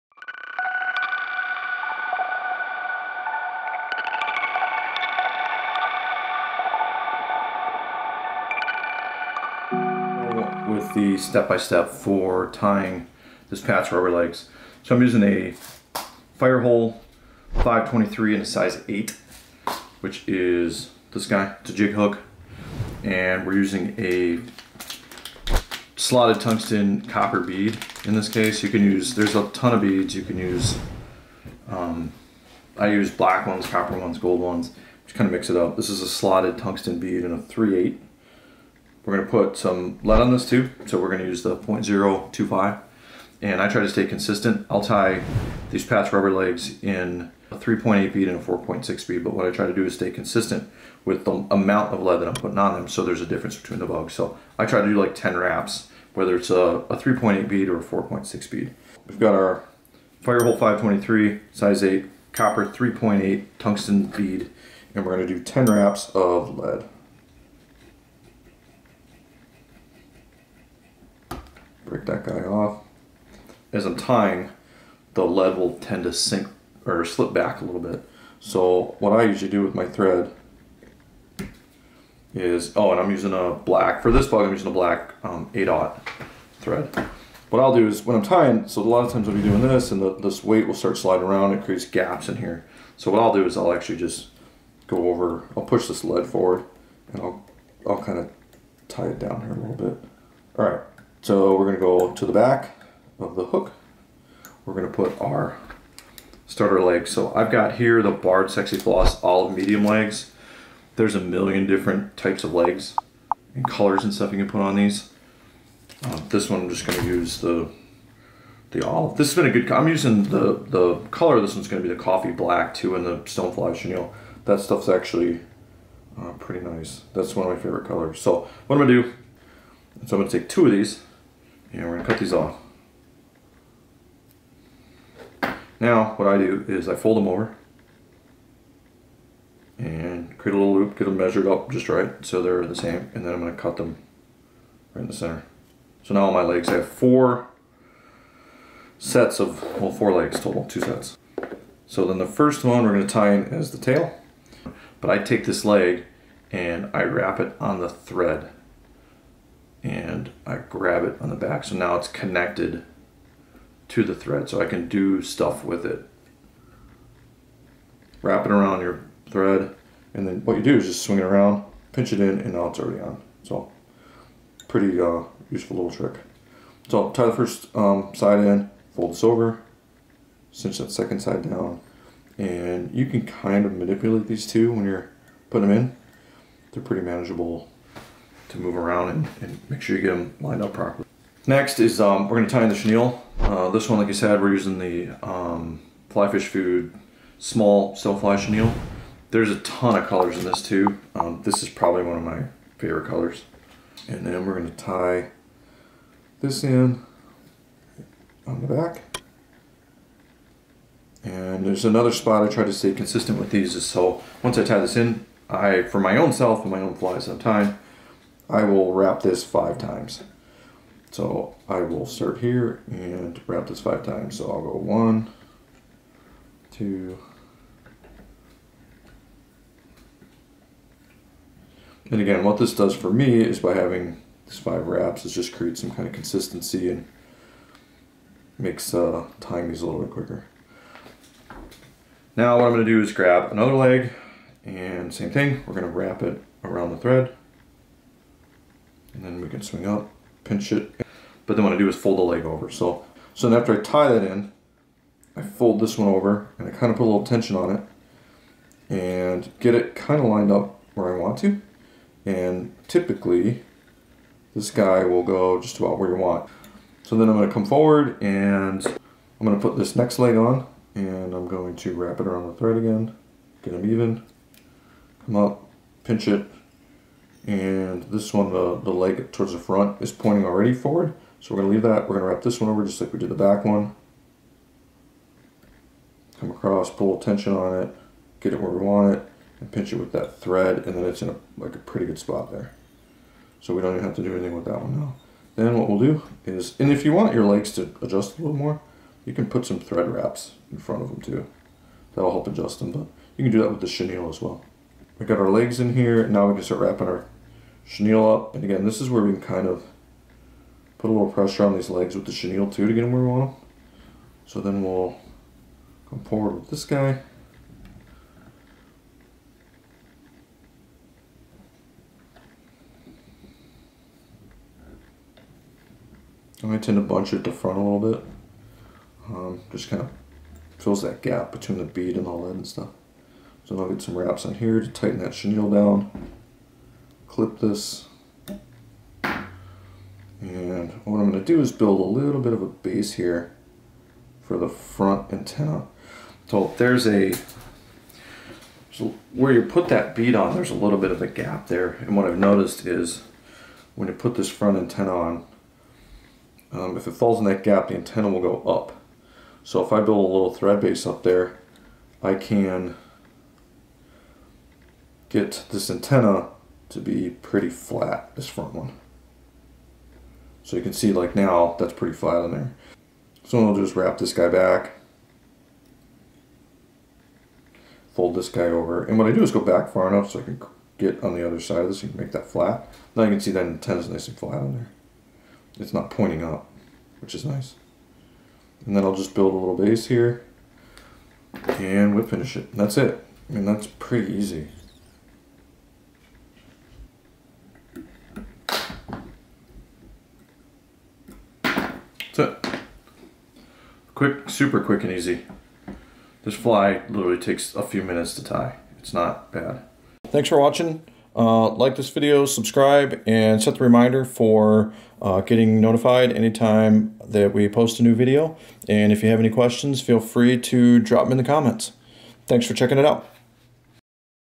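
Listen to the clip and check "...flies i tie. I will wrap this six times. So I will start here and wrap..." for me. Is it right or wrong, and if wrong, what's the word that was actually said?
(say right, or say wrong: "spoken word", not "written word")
wrong: "five", not "six".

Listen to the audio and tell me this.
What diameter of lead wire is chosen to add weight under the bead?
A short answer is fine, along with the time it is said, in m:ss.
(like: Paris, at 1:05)
0.025, at 0:41.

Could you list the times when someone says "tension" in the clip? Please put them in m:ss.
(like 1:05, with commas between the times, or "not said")
4:17, 4:47.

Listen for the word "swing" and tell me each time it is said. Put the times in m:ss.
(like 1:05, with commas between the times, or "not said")
2:51, 4:09.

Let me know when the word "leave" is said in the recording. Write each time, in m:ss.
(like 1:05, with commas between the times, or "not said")
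4:41.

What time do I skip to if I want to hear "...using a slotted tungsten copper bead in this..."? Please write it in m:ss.
0:23.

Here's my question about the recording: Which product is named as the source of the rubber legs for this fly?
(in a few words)
Barred Sexi-Floss.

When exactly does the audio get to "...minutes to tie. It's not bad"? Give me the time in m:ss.
6:48.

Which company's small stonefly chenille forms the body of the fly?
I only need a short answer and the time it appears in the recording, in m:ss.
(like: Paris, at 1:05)
Fly Fish Food, at 3:16.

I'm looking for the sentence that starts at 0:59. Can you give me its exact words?
We've got our Firehole 523, size 8, copper 3.8 tungsten bead, and we're going to do 10 wraps of lead.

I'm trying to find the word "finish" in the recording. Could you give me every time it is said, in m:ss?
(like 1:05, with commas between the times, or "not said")
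6:32.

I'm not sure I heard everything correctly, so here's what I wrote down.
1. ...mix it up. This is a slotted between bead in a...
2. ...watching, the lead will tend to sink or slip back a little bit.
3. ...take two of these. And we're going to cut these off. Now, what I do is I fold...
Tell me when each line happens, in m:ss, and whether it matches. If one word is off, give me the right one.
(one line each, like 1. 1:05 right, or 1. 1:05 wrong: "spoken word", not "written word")
1. 0:35 wrong: "tungsten", not "between"
2. 1:13 wrong: "tying", not "watching"
3. 2:10 right.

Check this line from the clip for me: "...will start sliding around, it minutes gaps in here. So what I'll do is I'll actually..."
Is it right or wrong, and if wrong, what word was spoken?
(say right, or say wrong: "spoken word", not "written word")
wrong: "creates", not "minutes".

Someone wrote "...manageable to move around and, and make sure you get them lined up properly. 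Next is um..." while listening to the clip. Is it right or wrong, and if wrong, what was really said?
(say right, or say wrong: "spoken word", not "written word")
right.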